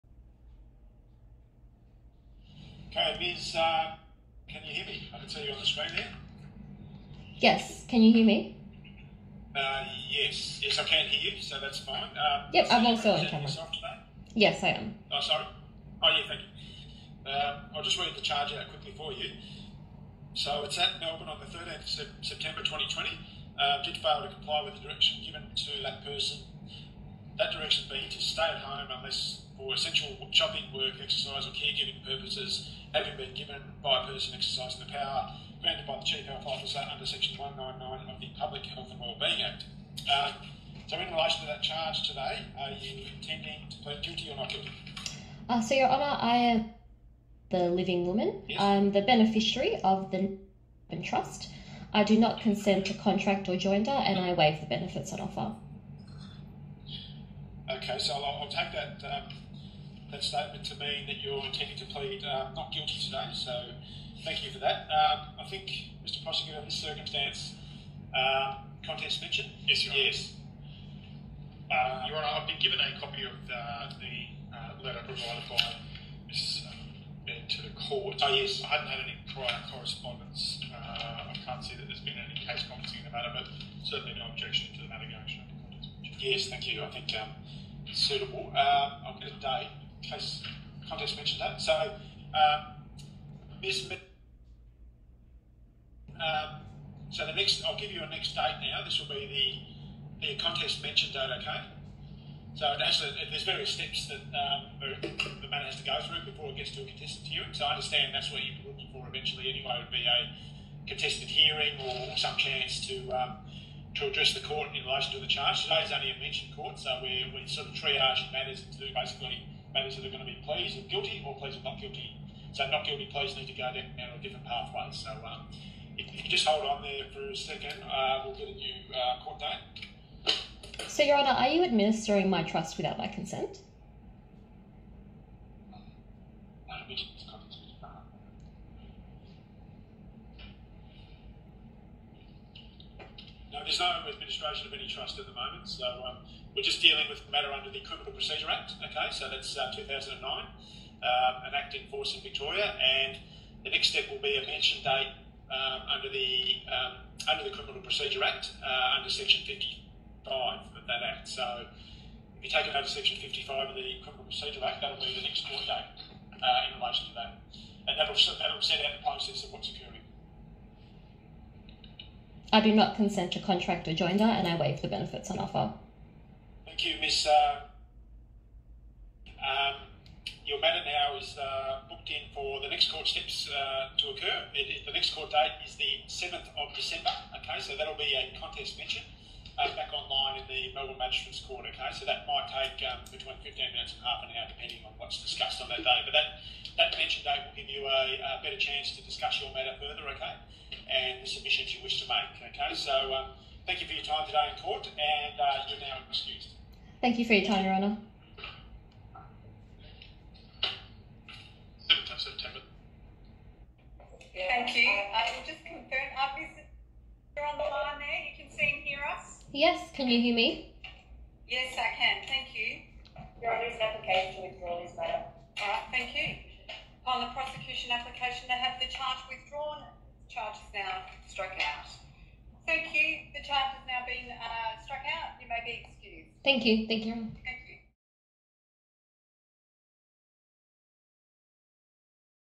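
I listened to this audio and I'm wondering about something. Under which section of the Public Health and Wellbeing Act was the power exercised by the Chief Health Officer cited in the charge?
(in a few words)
Section 199.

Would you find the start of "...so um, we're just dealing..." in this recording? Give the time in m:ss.
2:25.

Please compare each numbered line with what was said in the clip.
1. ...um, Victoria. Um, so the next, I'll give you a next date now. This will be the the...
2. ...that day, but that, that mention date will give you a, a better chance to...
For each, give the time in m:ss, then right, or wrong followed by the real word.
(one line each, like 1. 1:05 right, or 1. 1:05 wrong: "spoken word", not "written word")
1. 1:32 wrong: "Miss", not "Victoria"
2. 3:15 right.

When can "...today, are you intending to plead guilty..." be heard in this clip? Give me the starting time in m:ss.
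0:42.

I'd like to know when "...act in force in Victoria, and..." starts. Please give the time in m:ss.
2:31.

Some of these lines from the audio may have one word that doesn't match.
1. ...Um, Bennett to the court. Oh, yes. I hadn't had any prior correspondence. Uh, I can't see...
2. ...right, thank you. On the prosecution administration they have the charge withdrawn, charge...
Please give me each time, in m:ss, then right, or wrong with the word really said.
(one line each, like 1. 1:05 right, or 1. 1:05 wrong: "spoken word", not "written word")
1. 1:16 right
2. 3:45 wrong: "application", not "administration".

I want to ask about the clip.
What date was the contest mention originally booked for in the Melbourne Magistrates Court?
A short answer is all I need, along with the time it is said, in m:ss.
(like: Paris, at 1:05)
7 December, at 3:06.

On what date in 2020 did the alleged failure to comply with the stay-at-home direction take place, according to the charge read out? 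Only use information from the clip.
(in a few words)
13 September 2020.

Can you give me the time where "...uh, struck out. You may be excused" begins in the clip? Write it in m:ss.
3:54.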